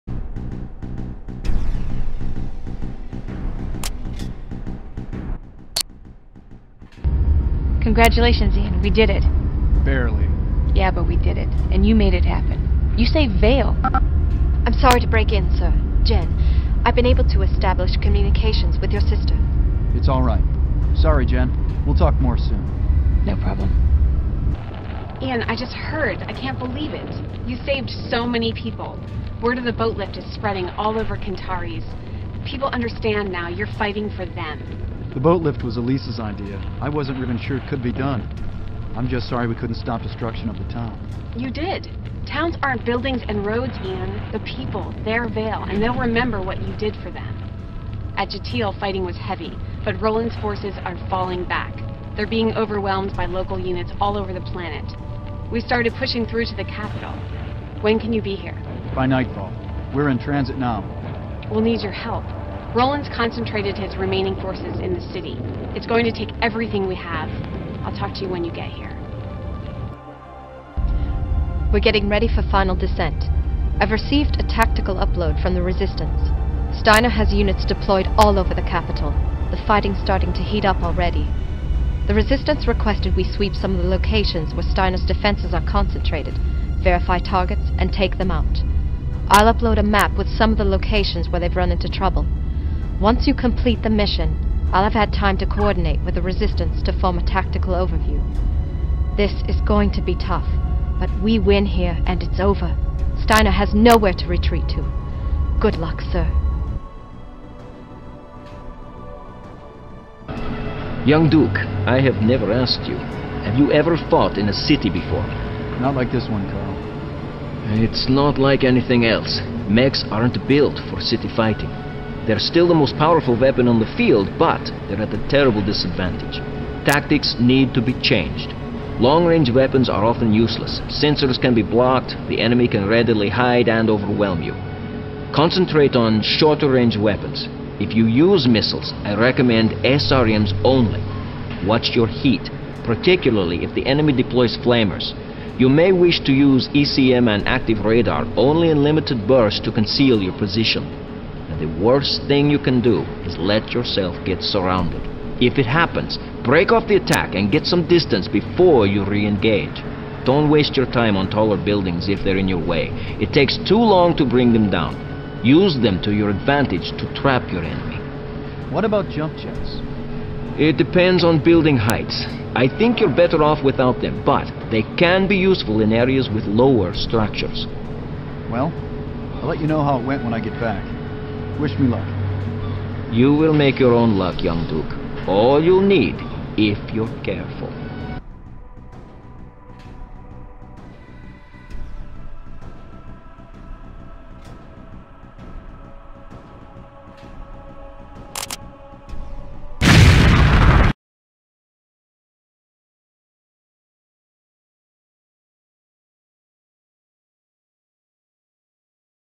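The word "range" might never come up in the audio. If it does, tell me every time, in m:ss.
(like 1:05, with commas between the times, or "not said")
2:09, 2:16.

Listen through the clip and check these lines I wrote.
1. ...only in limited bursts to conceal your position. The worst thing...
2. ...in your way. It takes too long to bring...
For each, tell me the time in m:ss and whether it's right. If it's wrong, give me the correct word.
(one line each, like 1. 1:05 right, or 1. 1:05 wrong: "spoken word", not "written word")
1. 2:28 right
2. 2:42 right.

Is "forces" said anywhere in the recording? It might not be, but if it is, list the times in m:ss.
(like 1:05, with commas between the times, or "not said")
0:50, 1:04.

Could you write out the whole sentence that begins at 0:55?
We started pushing through to the capital.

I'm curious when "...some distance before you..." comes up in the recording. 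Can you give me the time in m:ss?
2:37.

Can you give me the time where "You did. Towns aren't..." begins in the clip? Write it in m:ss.
0:41.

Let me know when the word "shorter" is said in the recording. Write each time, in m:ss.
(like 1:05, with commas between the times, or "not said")
2:16.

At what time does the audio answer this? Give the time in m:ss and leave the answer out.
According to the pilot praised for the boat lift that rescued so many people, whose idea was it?
0:35.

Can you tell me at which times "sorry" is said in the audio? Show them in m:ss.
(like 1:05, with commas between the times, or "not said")
0:14, 0:20, 0:39.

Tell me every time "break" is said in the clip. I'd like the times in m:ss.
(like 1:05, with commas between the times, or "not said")
0:15, 2:36.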